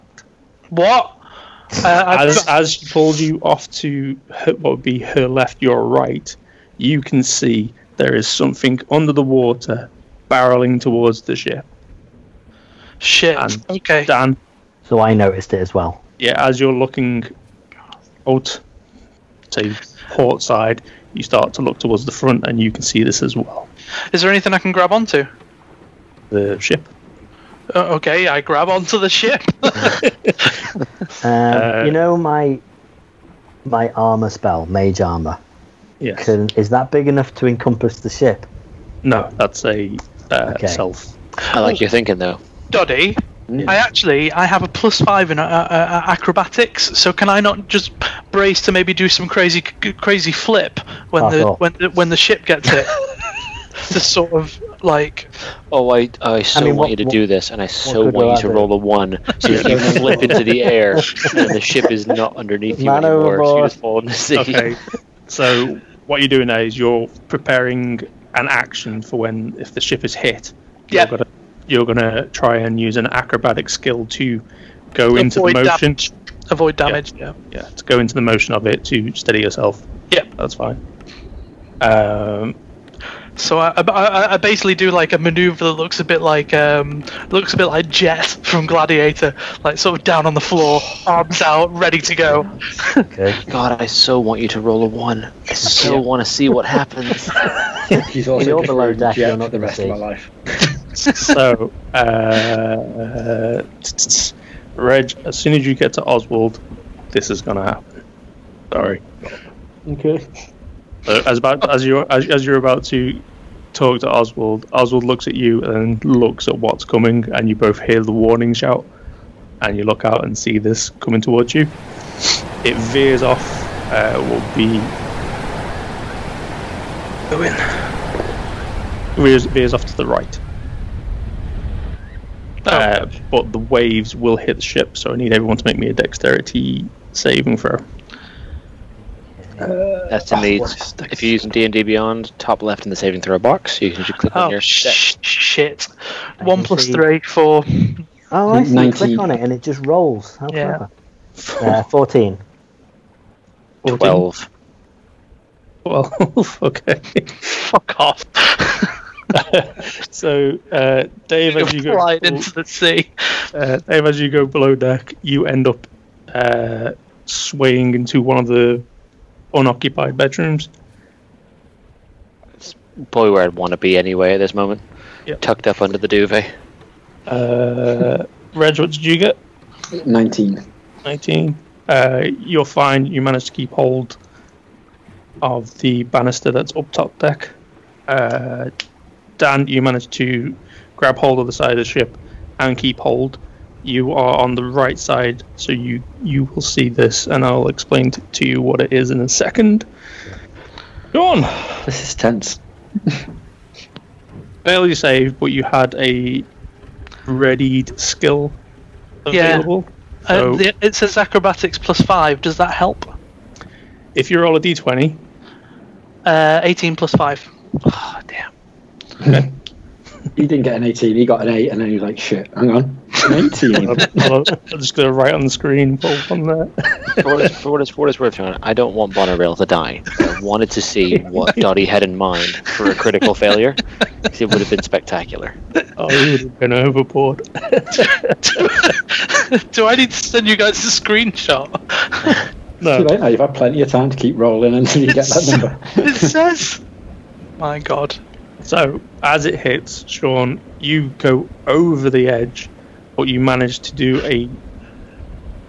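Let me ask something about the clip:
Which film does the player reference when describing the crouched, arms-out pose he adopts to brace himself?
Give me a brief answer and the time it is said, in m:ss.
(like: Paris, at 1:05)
Gladiator, at 1:28.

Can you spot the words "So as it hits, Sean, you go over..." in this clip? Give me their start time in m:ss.
4:08.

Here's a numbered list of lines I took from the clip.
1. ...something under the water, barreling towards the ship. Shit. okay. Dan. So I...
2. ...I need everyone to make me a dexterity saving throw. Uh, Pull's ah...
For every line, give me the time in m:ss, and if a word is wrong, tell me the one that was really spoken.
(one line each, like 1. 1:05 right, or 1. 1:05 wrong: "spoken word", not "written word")
1. 0:08 right
2. 2:15 wrong: "That", not "Pull".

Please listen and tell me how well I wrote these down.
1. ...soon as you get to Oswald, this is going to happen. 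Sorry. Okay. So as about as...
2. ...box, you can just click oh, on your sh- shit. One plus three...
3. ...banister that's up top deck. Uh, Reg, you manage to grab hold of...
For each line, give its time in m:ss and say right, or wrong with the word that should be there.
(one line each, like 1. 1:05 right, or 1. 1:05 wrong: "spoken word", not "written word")
1. 1:45 right
2. 2:23 right
3. 3:06 wrong: "Dan", not "Reg".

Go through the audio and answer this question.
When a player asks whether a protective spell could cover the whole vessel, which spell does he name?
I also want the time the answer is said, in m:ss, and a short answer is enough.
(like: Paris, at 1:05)
Mage armor, at 0:34.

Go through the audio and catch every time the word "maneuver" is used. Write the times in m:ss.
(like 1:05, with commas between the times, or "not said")
1:25.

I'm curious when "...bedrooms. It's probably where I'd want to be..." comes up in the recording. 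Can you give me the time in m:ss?
2:50.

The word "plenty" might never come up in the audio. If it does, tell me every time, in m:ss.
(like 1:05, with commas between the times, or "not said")
4:03.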